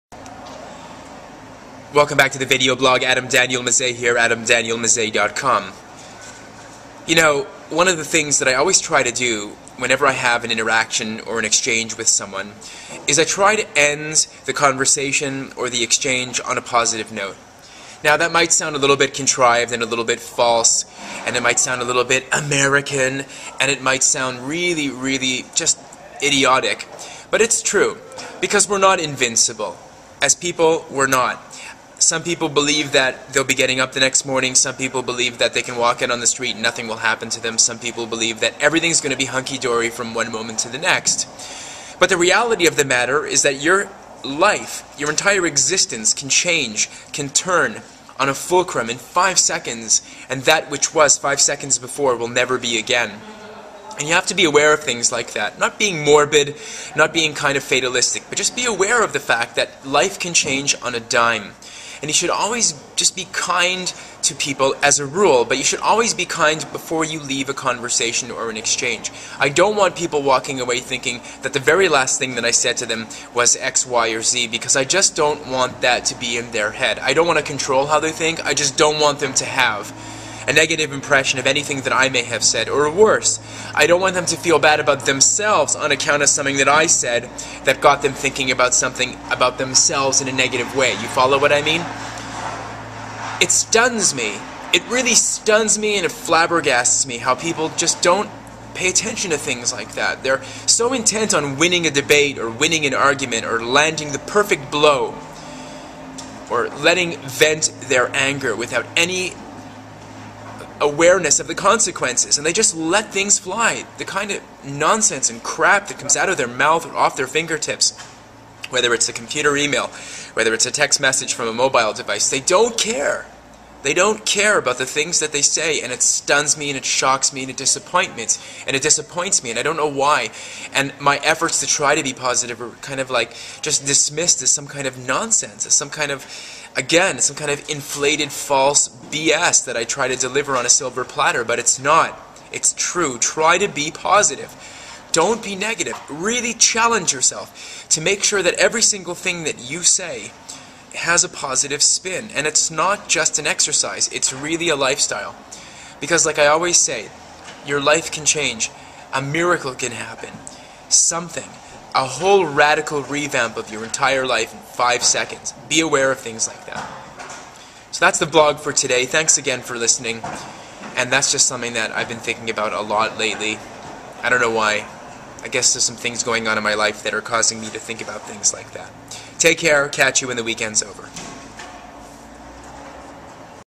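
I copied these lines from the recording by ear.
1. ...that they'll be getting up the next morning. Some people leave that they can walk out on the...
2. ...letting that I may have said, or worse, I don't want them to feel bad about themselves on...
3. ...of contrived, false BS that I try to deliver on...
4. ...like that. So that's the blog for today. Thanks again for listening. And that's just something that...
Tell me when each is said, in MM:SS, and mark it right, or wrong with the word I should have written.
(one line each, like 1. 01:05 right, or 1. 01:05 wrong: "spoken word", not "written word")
1. 00:32 wrong: "believe", not "leave"
2. 01:21 wrong: "anything", not "letting"
3. 02:17 wrong: "inflated", not "contrived"
4. 02:46 right.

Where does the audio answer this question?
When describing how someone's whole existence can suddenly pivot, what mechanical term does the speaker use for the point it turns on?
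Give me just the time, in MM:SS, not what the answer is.
00:48.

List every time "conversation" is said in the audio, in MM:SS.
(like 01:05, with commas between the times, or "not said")
00:14, 01:07.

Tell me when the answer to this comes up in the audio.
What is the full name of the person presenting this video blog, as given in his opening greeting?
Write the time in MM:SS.
00:03.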